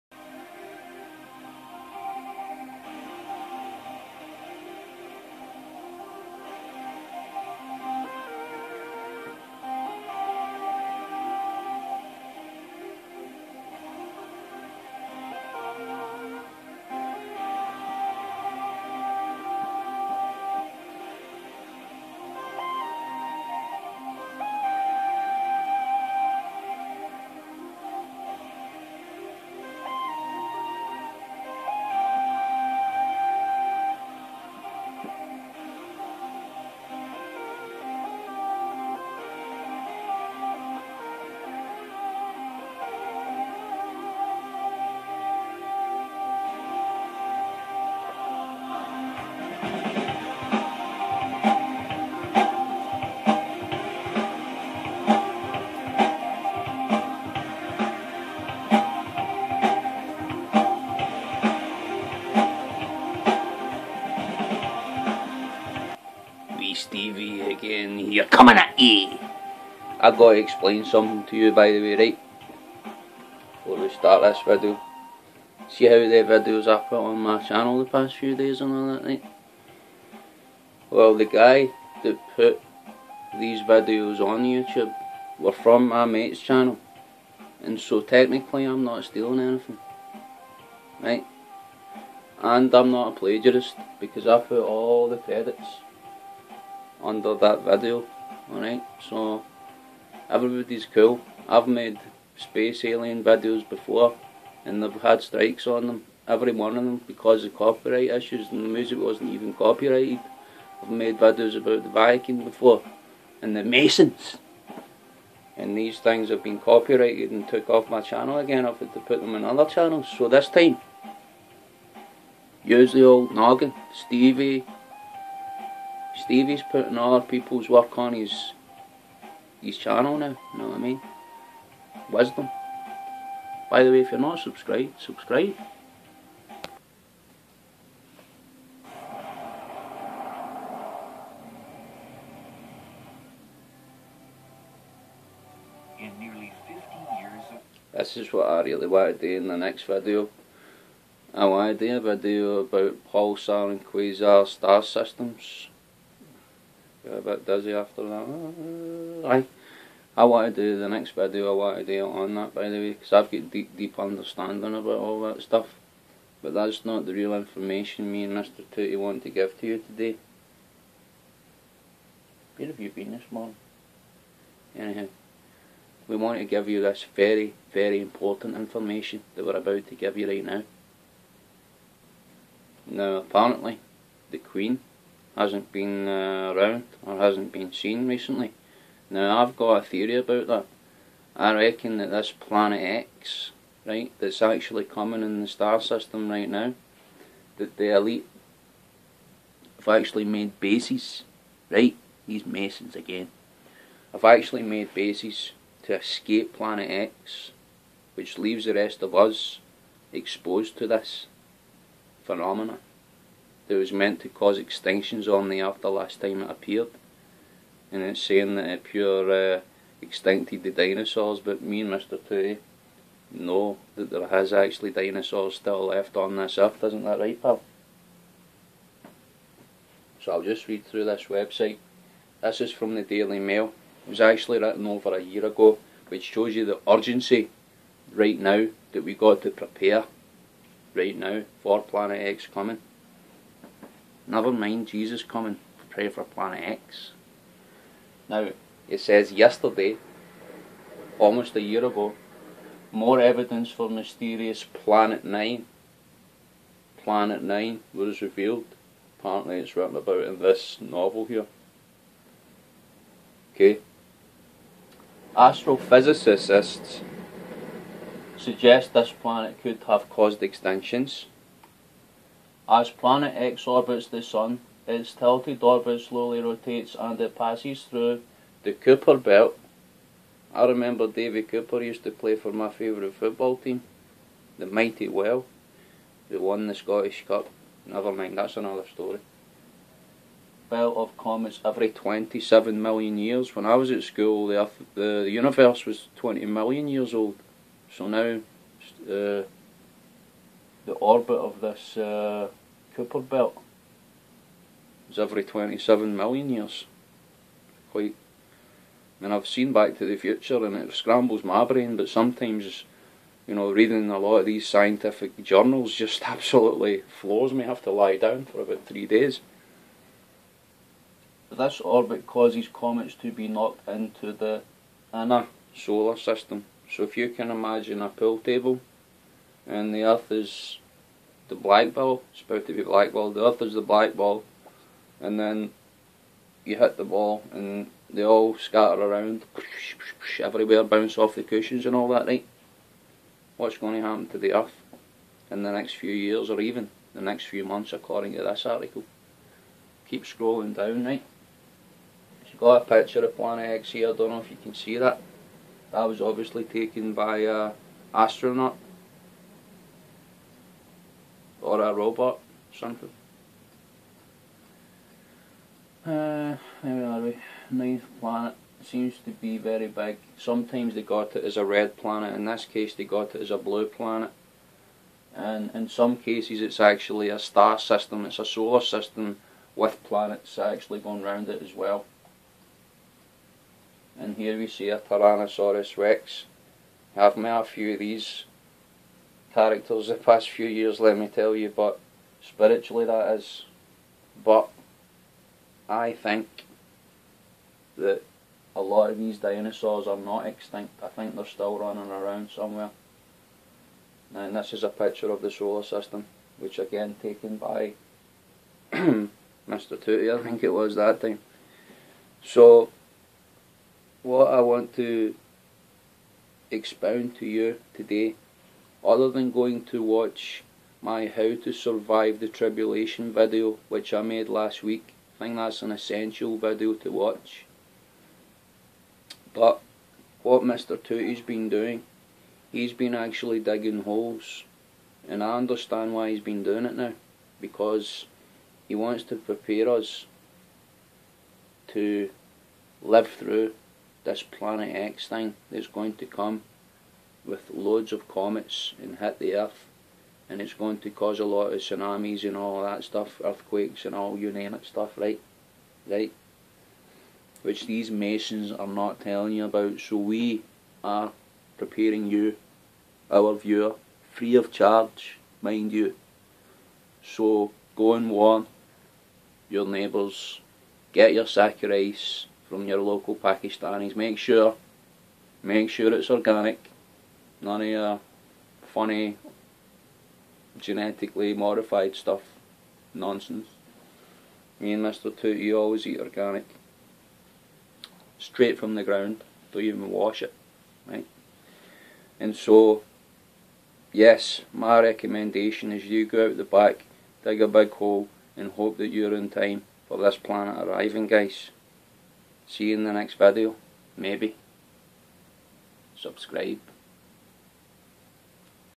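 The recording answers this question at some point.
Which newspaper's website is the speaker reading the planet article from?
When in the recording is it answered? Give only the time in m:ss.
3:53.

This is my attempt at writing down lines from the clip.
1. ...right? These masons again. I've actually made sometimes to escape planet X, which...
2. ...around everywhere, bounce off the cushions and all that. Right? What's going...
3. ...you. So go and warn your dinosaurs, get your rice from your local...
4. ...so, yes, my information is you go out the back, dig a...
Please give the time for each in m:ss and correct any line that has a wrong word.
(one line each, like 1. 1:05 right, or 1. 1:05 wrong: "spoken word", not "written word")
1. 3:21 wrong: "bases", not "sometimes"
2. 5:39 right
3. 7:45 wrong: "neighbours", not "dinosaurs"
4. 8:12 wrong: "recommendation", not "information".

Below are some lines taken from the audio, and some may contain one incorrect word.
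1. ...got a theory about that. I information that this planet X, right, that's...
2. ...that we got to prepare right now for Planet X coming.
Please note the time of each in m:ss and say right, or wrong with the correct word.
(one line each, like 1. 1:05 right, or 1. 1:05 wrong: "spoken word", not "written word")
1. 3:09 wrong: "reckon", not "information"
2. 3:58 right.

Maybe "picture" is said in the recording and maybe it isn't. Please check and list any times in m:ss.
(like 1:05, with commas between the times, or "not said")
5:52, 6:44.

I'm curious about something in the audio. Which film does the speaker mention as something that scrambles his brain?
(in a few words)
Back to the Future.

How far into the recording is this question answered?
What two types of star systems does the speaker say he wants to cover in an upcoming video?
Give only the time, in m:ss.
2:33.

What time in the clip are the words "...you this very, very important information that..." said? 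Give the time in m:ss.
2:56.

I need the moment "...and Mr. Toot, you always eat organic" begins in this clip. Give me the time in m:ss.
8:04.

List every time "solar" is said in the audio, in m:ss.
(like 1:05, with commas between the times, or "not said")
5:25, 6:18, 6:45.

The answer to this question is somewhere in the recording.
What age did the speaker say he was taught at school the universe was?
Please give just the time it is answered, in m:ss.
4:56.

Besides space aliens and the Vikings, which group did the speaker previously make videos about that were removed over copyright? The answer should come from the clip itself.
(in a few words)
The Masons.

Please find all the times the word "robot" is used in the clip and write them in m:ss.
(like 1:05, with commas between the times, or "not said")
6:01.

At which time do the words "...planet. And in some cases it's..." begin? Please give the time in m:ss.
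6:13.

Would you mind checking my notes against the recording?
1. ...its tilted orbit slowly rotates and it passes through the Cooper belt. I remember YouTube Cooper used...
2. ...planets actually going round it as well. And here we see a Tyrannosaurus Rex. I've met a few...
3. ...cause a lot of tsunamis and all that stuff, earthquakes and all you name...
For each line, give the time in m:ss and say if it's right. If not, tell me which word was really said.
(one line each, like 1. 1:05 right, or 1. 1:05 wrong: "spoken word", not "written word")
1. 4:34 wrong: "David", not "YouTube"
2. 6:20 right
3. 7:31 right.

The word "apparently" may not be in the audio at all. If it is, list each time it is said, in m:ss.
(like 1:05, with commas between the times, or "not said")
3:03, 4:19.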